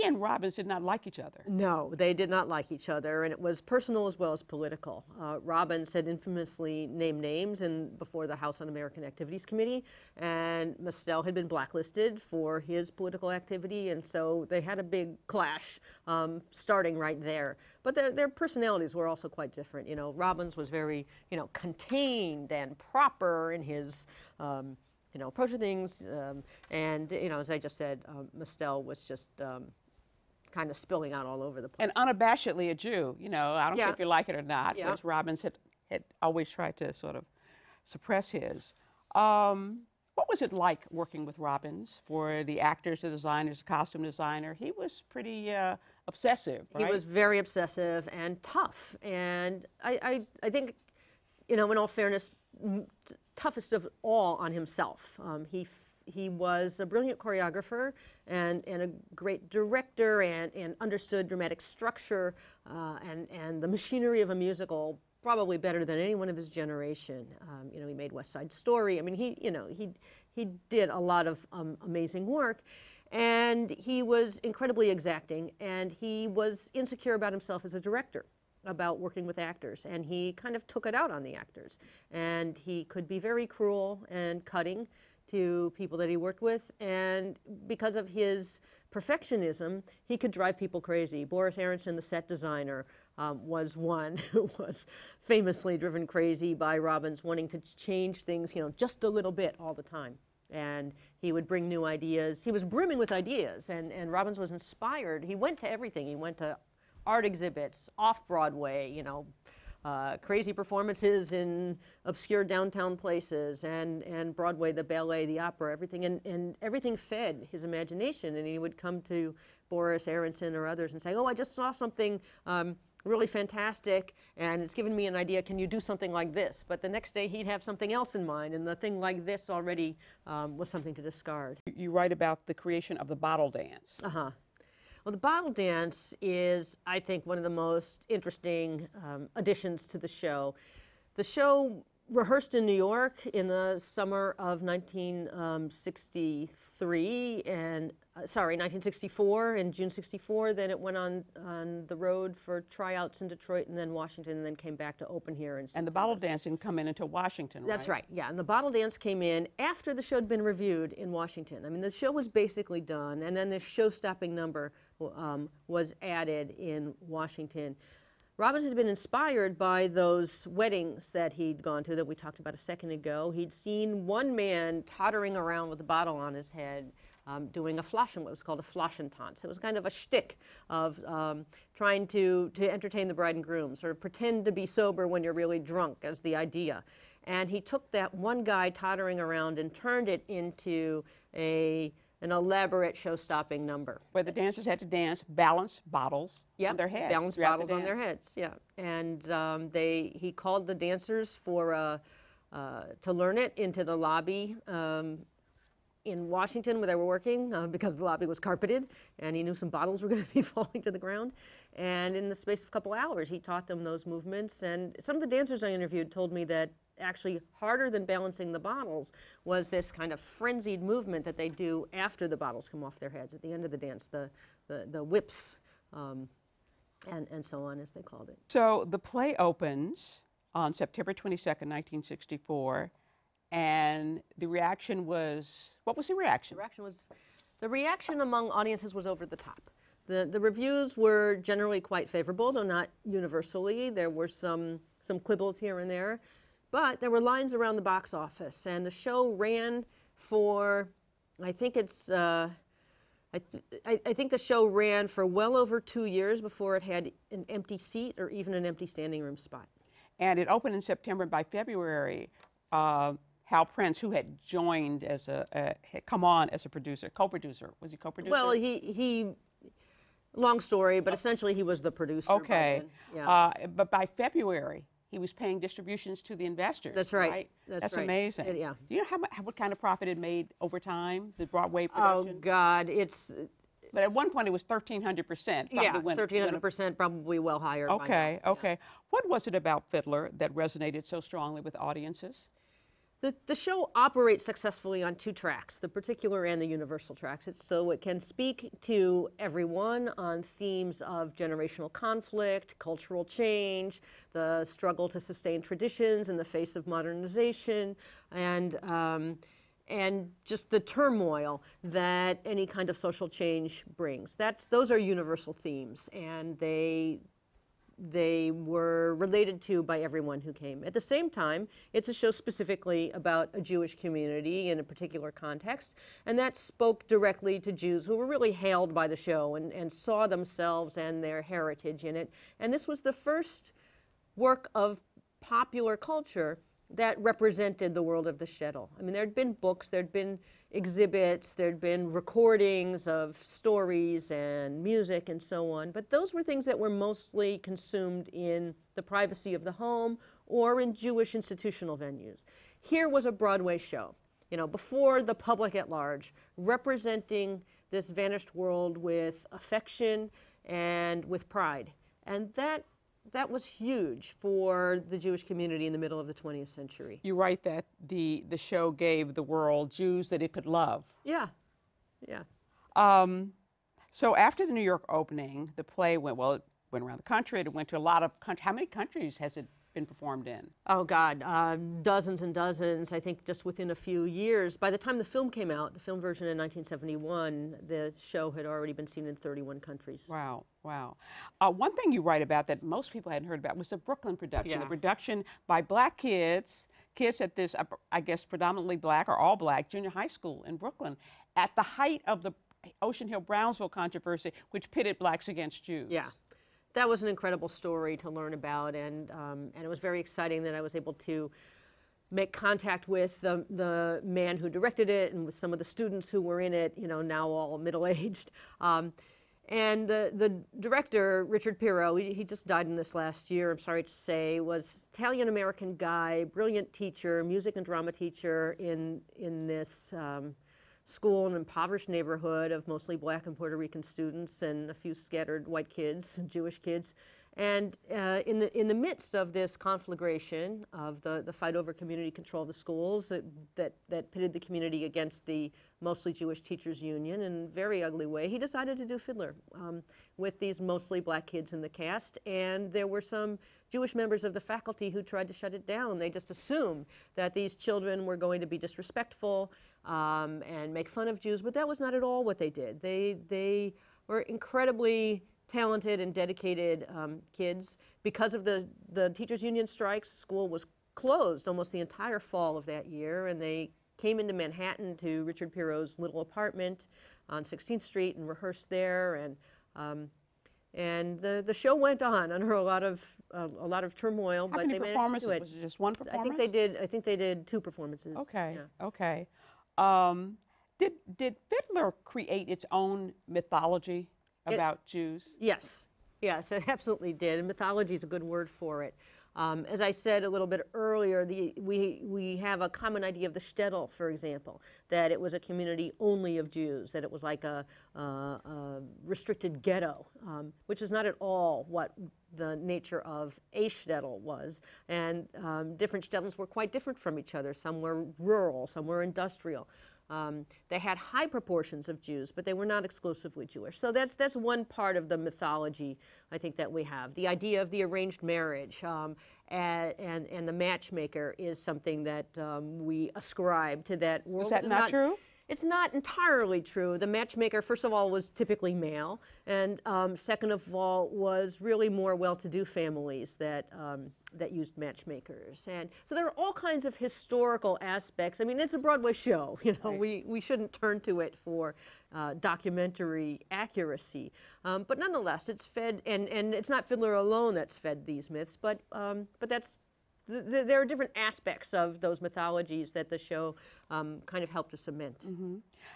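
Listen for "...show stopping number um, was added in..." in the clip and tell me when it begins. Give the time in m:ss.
2:43.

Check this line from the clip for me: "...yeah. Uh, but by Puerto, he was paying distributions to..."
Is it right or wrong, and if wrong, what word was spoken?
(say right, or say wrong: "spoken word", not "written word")
wrong: "February", not "Puerto".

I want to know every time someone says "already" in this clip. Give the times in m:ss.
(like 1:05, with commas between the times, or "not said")
2:09, 6:28.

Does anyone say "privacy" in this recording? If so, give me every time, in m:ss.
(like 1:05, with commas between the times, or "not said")
5:49.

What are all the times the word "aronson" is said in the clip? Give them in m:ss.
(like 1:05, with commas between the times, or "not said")
1:31, 2:00.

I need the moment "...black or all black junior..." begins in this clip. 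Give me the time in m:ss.
6:38.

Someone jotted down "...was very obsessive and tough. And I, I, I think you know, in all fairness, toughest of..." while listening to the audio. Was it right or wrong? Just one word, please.
right.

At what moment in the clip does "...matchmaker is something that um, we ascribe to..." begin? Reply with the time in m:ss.
8:50.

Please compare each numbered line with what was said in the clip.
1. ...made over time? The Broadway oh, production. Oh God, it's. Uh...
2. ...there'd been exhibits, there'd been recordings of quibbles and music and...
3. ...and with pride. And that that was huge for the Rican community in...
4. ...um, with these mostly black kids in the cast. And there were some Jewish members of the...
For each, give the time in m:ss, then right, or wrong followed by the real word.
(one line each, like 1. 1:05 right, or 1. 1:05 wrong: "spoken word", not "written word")
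1. 4:40 right
2. 5:39 wrong: "stories", not "quibbles"
3. 6:00 wrong: "Jewish", not "Rican"
4. 7:29 right.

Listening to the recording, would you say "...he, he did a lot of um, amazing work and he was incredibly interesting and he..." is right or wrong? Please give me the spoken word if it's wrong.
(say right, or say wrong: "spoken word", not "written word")
wrong: "exacting", not "interesting".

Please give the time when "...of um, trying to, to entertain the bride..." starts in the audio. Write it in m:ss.
3:00.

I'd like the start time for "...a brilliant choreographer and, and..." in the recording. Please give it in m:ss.
0:56.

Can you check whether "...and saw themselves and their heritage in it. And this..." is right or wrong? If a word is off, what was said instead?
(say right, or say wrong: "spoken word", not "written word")
right.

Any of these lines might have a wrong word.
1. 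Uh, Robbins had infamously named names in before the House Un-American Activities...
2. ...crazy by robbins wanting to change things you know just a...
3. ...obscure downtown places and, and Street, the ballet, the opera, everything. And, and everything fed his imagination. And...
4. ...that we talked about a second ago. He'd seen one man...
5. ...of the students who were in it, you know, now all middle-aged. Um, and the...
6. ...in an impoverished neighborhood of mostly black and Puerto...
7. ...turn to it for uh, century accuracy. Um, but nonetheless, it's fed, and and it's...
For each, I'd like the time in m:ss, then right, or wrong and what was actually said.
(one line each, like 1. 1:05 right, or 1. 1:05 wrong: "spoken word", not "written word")
1. 0:05 right
2. 1:36 right
3. 1:52 wrong: "Broadway", not "Street"
4. 2:51 right
5. 6:55 right
6. 7:11 right
7. 9:10 wrong: "documentary", not "century".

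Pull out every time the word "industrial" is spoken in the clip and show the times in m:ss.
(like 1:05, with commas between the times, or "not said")
8:39.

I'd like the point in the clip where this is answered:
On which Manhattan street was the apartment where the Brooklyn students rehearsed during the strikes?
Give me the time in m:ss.
7:57.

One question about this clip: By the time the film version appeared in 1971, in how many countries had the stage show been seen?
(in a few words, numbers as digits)
31.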